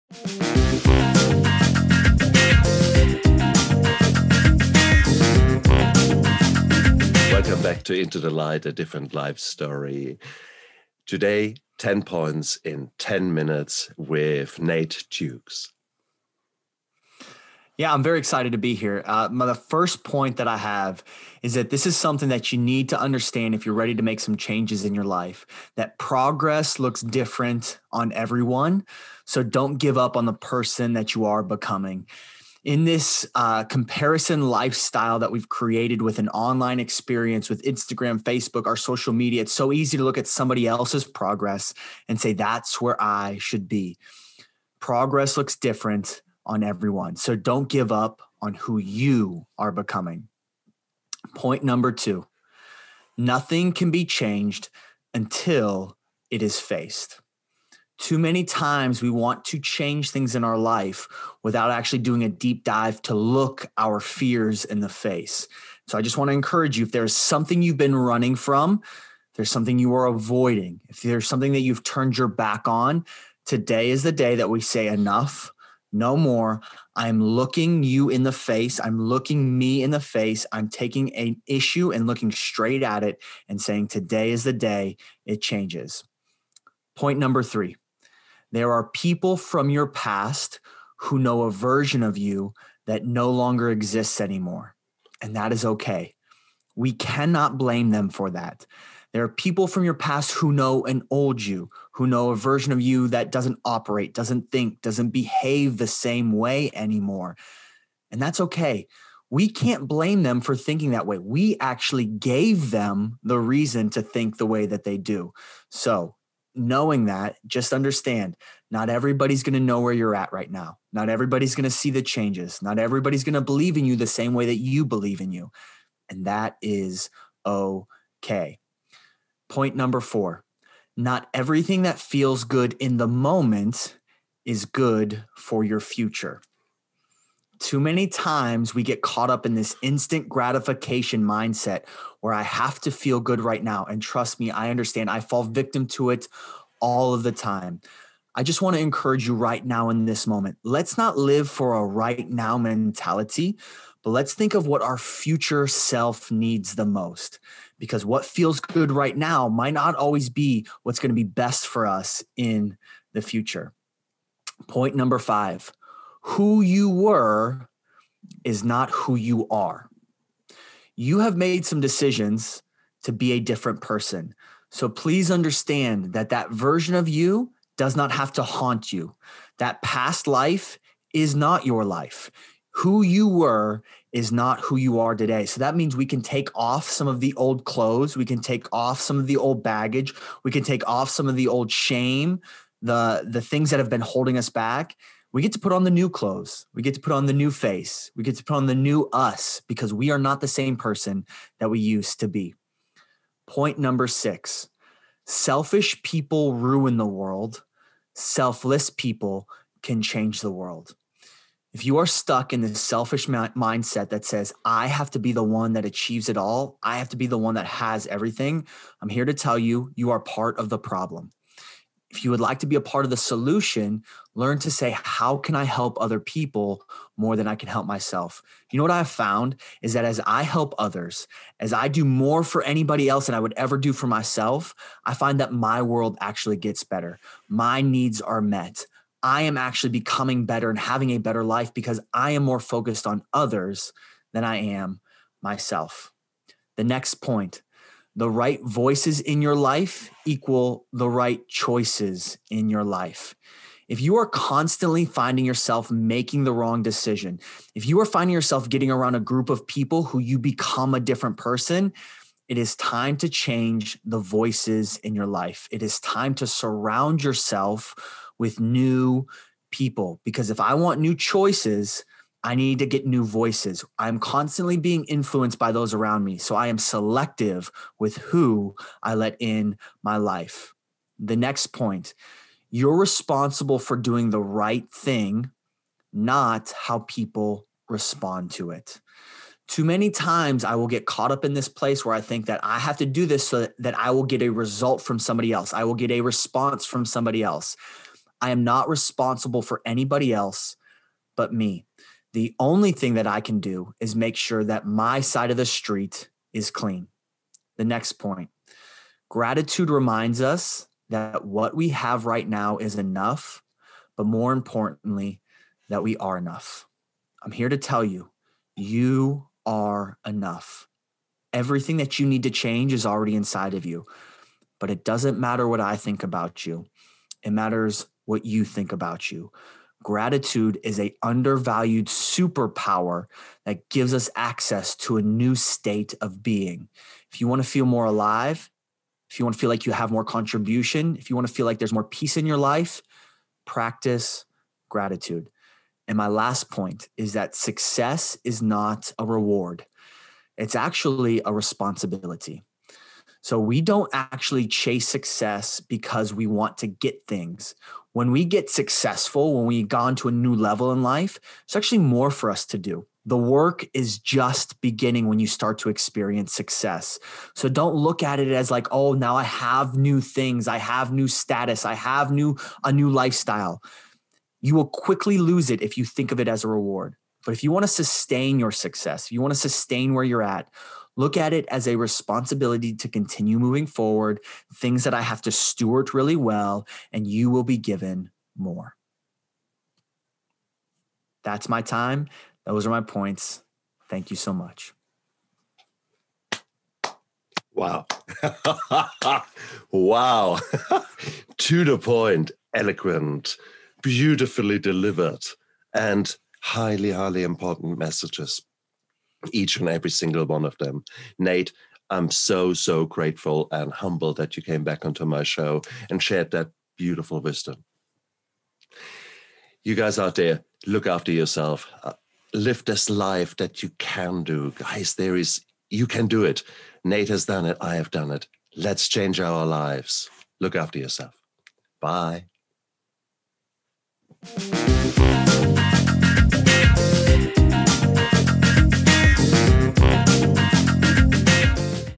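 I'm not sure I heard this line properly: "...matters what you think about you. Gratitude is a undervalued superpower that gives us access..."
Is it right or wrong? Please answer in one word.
right.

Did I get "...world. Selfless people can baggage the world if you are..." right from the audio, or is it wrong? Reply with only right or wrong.
wrong.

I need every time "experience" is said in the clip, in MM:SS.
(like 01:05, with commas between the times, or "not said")
00:36, 06:05.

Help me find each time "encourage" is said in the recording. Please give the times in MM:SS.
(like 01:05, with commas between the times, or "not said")
01:06, 02:28.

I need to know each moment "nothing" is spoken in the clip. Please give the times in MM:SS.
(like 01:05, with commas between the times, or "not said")
00:53.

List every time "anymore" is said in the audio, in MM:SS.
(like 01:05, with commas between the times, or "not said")
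01:34, 01:46.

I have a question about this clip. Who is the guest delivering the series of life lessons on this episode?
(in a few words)
Nate Dukes.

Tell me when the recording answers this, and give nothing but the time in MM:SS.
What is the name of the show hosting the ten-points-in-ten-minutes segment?
00:07.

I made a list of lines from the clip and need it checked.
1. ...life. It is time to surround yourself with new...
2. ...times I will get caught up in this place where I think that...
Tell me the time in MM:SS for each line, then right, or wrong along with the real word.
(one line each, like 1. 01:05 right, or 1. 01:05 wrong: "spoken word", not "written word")
1. 04:25 right
2. 04:50 right.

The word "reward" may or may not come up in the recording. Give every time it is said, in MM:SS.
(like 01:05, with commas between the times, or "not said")
05:49, 06:16.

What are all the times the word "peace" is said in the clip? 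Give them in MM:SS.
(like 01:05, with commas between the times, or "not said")
05:42.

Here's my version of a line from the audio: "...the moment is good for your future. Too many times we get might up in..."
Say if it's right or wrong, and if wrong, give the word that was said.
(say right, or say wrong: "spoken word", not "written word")
wrong: "caught", not "might".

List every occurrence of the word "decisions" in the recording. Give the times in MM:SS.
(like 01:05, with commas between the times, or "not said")
02:51, 04:16.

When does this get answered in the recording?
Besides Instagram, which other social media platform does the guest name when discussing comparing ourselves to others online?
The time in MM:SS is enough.
00:38.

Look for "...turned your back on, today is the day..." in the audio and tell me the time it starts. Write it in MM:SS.
01:11.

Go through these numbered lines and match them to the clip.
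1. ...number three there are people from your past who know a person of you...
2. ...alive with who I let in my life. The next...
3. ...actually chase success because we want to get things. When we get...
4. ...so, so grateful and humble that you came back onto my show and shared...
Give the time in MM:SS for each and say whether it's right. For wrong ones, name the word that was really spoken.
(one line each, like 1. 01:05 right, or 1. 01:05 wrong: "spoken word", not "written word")
1. 01:27 wrong: "version", not "person"
2. 04:36 wrong: "selective", not "alive"
3. 05:54 right
4. 06:52 right.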